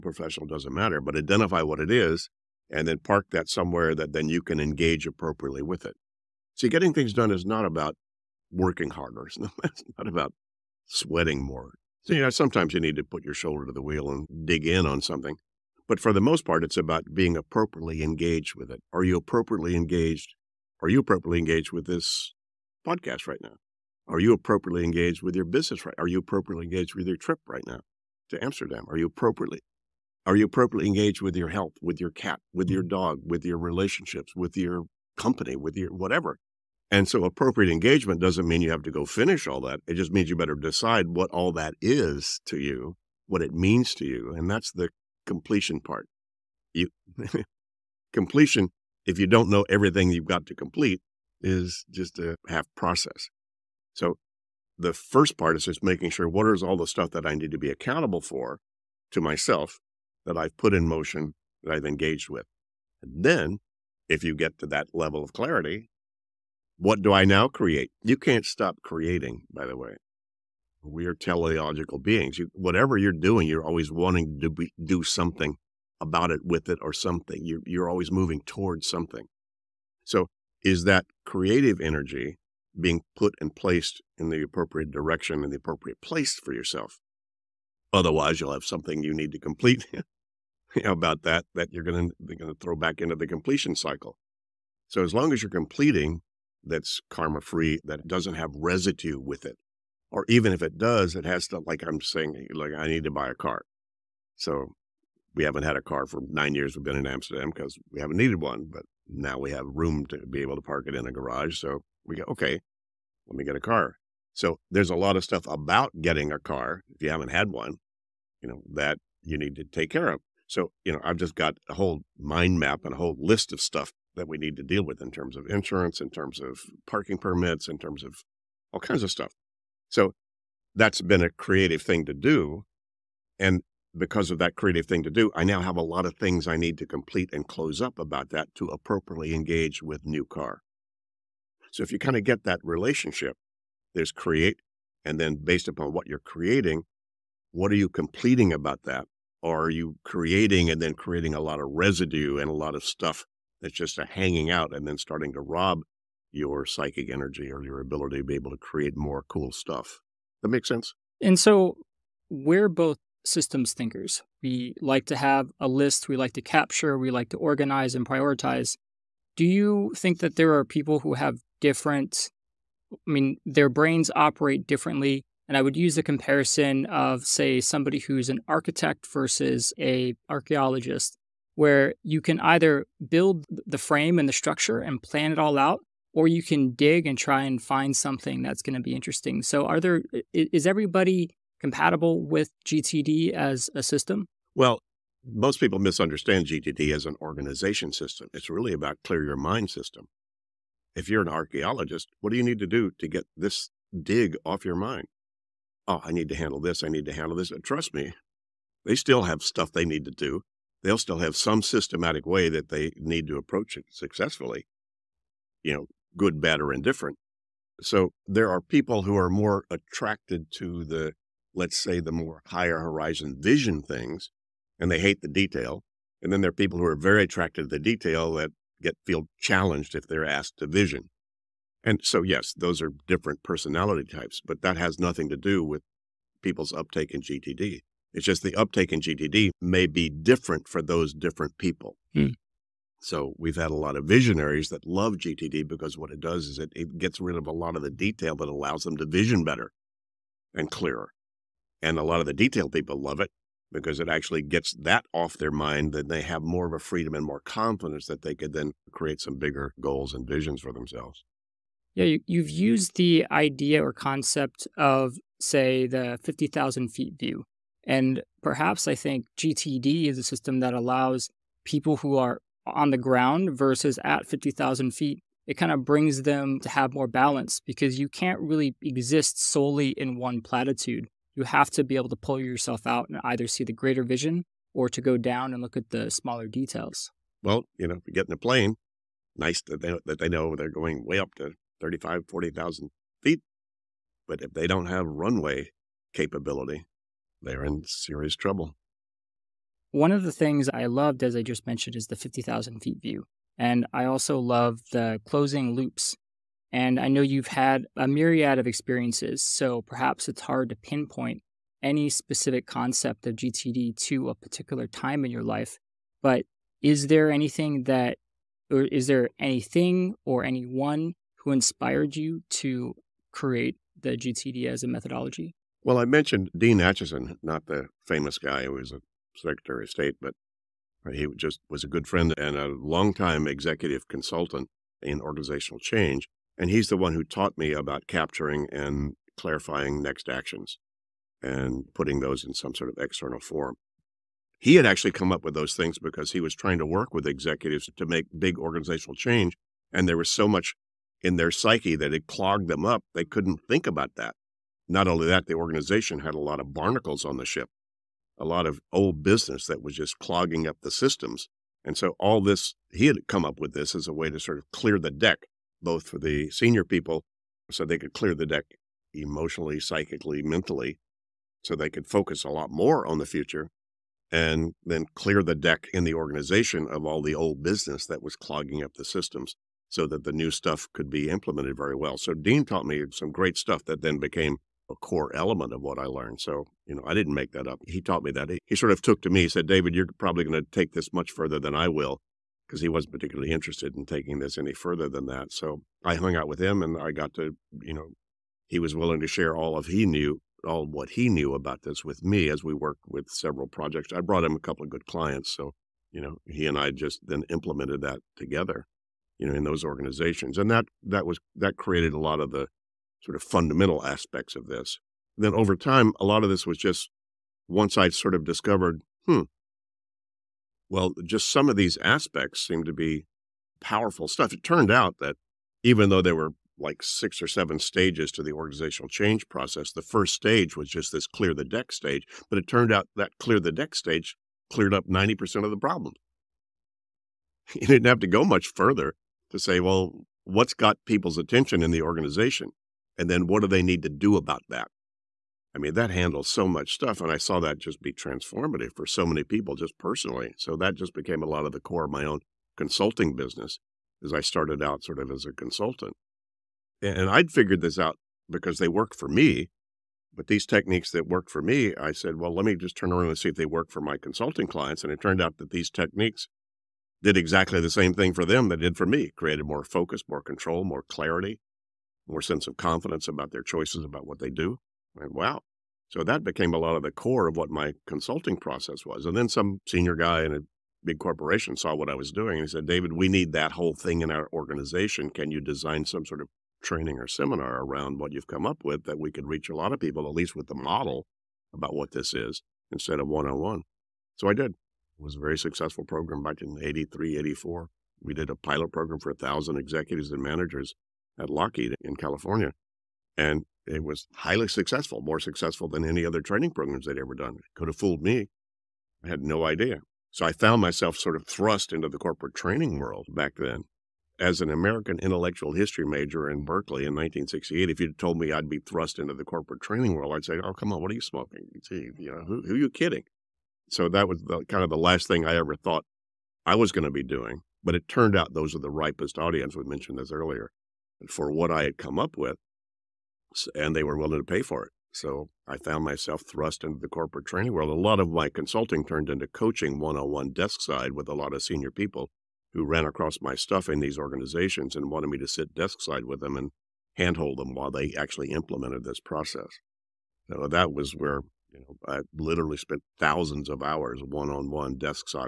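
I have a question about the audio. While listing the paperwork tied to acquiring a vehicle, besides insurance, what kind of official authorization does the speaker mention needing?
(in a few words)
Parking permits.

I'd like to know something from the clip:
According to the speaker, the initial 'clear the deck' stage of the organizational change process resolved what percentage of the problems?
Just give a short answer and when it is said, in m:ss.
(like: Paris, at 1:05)
90%, at 7:15.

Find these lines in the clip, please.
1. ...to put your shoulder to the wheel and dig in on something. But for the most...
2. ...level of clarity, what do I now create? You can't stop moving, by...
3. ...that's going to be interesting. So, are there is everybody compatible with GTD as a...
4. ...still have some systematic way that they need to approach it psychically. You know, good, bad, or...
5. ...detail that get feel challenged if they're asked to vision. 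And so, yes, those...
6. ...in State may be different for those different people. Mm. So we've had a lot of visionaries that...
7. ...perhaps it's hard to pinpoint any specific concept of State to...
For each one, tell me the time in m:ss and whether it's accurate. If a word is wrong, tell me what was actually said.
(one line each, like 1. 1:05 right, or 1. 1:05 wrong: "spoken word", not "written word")
1. 0:12 right
2. 1:04 wrong: "creating", not "moving"
3. 3:08 right
4. 3:30 wrong: "successfully", not "psychically"
5. 3:47 right
6. 3:58 wrong: "GTD", not "State"
7. 5:09 wrong: "GTD", not "State".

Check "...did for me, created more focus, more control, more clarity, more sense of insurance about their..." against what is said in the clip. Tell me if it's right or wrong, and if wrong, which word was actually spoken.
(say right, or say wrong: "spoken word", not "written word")
wrong: "confidence", not "insurance".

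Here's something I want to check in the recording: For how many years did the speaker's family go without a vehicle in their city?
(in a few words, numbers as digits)
9.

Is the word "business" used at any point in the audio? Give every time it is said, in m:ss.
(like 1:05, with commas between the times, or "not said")
0:25, 5:59, 6:17, 7:33.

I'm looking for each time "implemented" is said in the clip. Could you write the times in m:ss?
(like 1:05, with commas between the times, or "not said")
6:21, 6:47, 9:08.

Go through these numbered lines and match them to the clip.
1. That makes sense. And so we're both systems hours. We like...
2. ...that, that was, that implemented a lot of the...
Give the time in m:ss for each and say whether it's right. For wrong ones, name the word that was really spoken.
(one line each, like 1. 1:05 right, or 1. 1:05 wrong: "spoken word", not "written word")
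1. 2:40 wrong: "thinkers", not "hours"
2. 6:50 wrong: "created", not "implemented".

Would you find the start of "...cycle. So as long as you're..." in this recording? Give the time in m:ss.
1:33.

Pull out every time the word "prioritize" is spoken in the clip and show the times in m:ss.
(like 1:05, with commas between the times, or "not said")
2:48.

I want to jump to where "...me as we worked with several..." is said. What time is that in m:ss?
6:42.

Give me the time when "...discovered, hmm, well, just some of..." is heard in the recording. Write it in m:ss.
6:58.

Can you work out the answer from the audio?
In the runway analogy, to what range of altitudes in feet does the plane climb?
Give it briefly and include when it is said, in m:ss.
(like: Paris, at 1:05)
35,000 to 40,000 feet, at 4:51.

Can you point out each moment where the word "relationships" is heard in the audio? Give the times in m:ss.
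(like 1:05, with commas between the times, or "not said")
0:33, 2:22.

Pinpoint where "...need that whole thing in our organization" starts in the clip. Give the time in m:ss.
8:03.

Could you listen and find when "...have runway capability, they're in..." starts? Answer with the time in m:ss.
4:54.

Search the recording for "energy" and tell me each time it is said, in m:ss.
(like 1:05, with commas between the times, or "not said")
1:21, 2:37.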